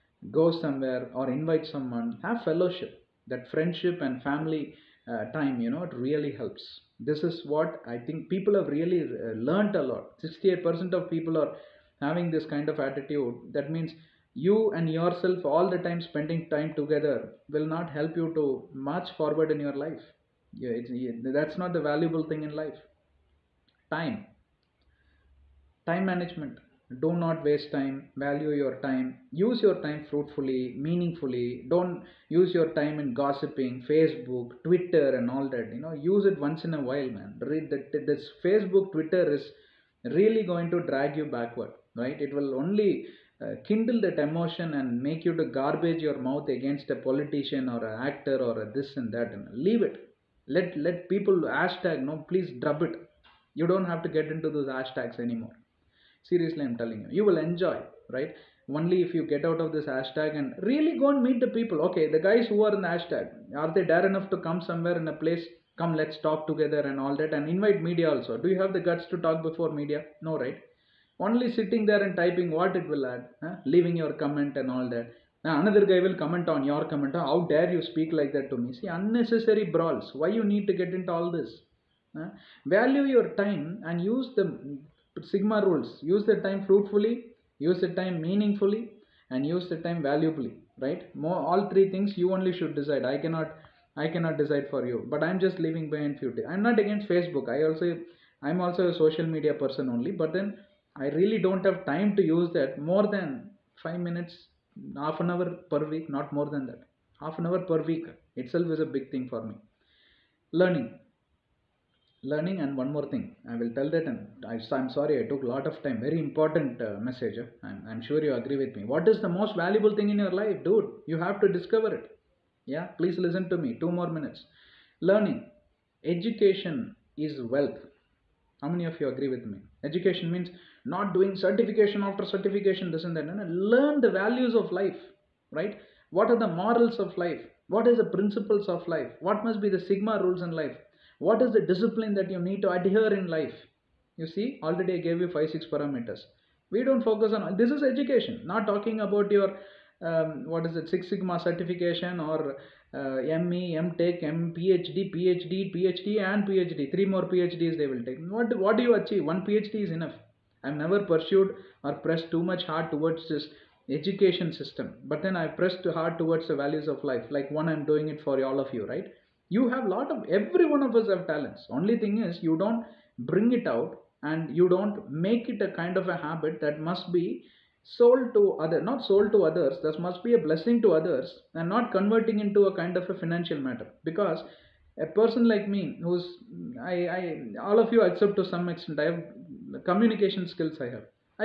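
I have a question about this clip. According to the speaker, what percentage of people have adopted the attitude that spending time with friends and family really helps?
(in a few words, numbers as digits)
68%.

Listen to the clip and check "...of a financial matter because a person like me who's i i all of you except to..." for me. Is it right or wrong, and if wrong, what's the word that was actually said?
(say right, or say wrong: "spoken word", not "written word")
right.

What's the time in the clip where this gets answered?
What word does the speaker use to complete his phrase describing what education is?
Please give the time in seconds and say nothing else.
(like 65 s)
126 s.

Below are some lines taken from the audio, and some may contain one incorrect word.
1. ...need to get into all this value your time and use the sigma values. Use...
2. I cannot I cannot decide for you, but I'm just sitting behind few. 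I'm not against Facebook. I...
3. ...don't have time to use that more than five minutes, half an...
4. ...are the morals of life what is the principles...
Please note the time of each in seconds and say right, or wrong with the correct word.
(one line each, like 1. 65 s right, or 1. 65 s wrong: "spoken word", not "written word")
1. 80 s wrong: "rules", not "values"
2. 93 s wrong: "leaving", not "sitting"
3. 101 s right
4. 136 s right.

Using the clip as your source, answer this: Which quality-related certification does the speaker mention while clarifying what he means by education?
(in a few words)
Six Sigma.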